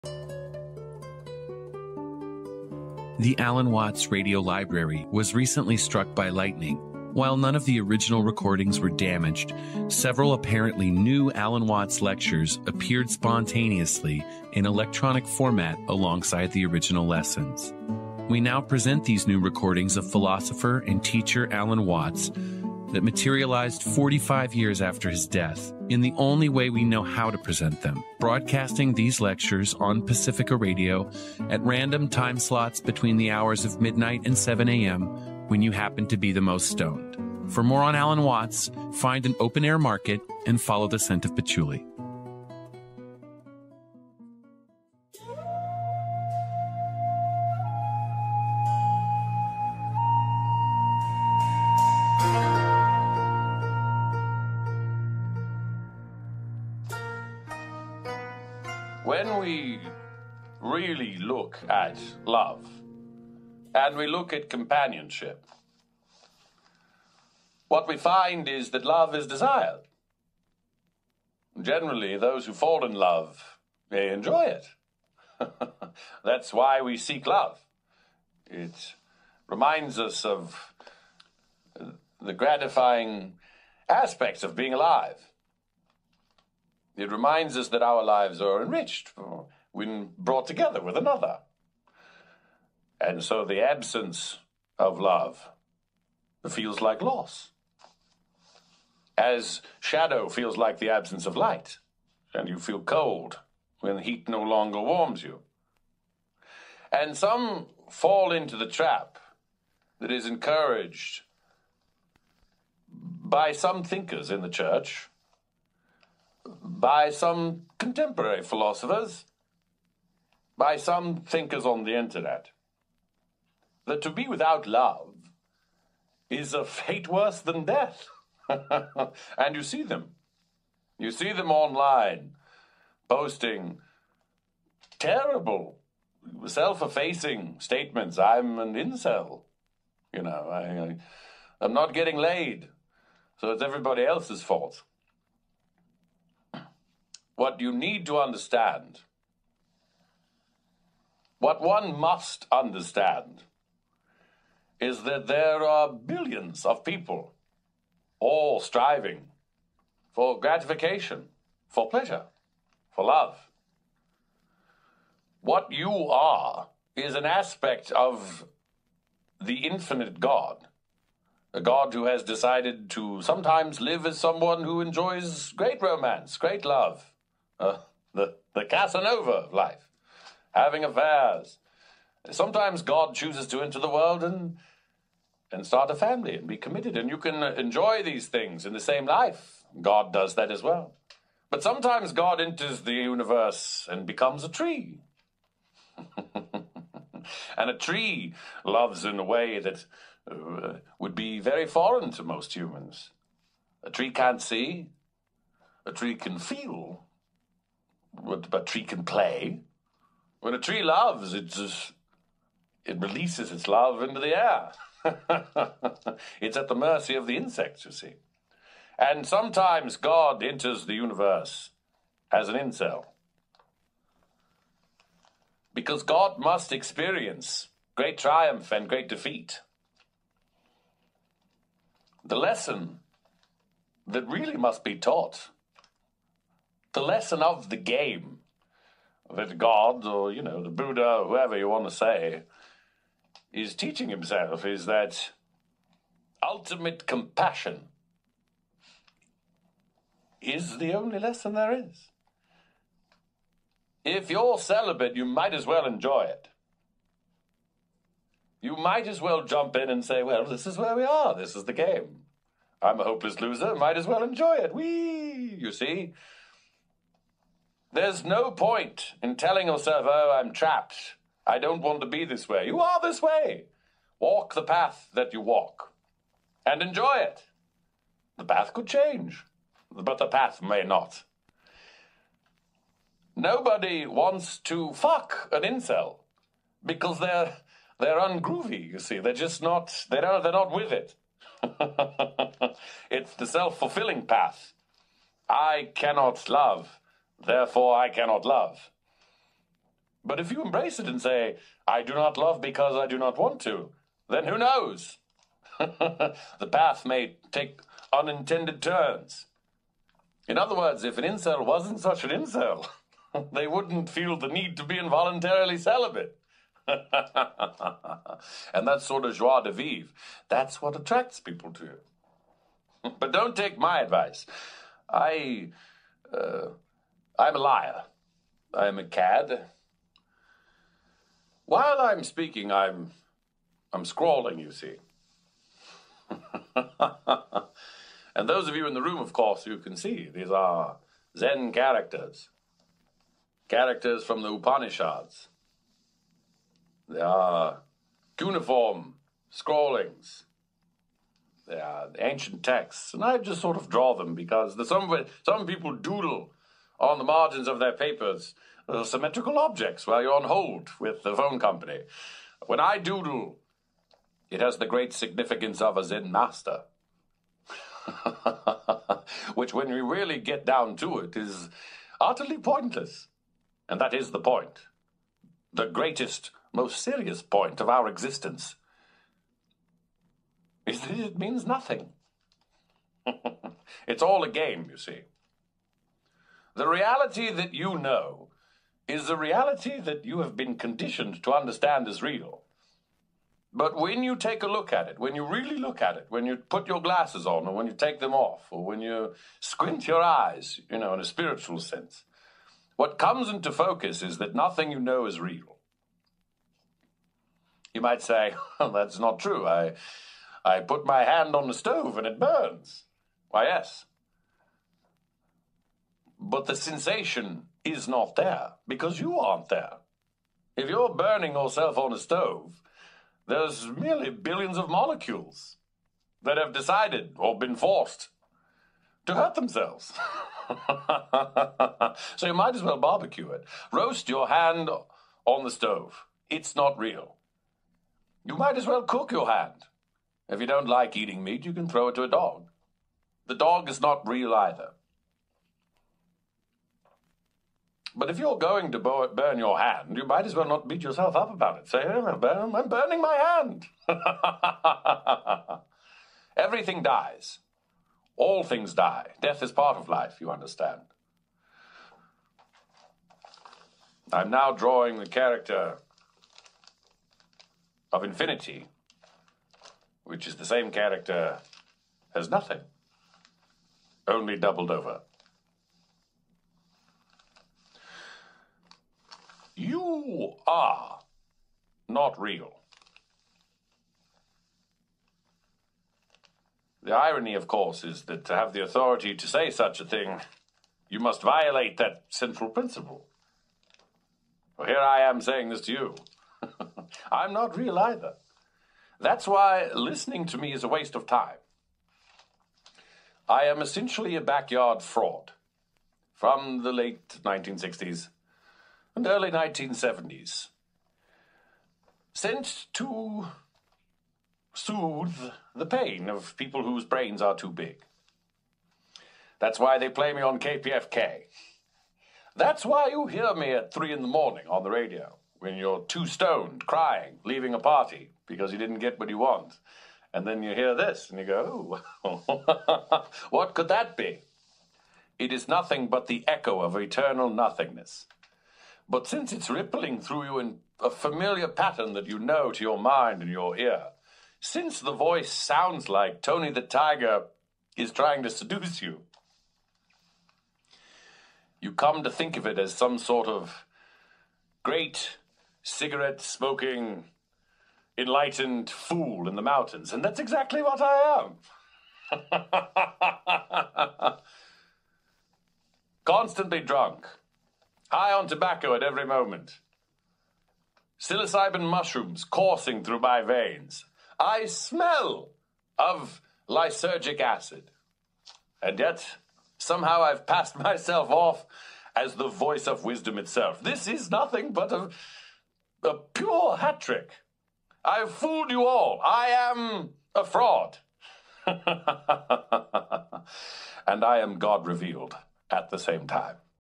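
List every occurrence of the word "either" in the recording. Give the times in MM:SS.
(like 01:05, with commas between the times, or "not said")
07:24, 08:17.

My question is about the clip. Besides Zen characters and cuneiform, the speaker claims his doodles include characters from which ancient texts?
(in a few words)
The Upanishads.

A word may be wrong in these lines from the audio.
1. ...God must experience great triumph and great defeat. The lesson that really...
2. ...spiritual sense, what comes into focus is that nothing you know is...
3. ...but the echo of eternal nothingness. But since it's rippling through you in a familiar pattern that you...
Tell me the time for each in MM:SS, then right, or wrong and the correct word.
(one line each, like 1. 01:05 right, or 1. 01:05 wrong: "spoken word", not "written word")
1. 03:46 right
2. 06:41 right
3. 08:56 right.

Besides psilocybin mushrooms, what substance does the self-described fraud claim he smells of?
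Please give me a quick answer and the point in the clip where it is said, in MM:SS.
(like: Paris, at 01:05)
Lysergic acid, at 09:36.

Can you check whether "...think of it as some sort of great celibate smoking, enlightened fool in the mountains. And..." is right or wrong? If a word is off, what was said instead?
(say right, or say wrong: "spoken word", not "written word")
wrong: "cigarette", not "celibate".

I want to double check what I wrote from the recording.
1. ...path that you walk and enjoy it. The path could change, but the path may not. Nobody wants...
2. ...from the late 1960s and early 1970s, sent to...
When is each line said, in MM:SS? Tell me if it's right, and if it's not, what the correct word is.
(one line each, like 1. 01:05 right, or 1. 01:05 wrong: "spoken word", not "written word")
1. 04:34 right
2. 08:26 right.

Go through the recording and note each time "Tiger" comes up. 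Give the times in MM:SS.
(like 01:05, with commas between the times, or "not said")
09:06.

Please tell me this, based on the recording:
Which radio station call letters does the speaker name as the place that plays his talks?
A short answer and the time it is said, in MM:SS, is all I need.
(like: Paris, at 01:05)
KPFK, at 08:40.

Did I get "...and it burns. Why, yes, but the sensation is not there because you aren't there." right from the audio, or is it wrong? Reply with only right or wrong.
right.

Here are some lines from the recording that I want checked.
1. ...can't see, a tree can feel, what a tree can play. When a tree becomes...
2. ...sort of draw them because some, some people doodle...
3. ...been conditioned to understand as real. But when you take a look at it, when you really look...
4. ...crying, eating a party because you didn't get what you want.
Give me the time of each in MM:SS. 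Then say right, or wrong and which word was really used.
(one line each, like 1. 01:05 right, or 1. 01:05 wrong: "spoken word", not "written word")
1. 03:24 wrong: "loves", not "becomes"
2. 05:53 right
3. 06:30 right
4. 08:46 wrong: "leaving", not "eating".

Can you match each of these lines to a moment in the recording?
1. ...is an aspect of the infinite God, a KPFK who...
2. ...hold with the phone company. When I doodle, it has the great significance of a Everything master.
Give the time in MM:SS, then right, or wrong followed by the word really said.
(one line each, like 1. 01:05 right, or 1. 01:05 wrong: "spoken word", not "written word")
1. 02:46 wrong: "God", not "KPFK"
2. 06:00 wrong: "Zen", not "Everything".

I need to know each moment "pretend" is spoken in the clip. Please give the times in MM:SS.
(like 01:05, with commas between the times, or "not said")
not said.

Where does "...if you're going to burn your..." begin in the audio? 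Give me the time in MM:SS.
07:28.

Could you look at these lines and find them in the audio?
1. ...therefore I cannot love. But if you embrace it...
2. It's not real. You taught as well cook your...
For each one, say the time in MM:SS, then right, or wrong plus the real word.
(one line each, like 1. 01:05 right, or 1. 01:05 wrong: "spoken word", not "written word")
1. 04:57 right
2. 07:16 wrong: "might", not "taught".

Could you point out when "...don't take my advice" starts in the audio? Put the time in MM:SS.
05:23.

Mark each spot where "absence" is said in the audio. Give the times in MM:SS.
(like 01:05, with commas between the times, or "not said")
01:33, 01:40.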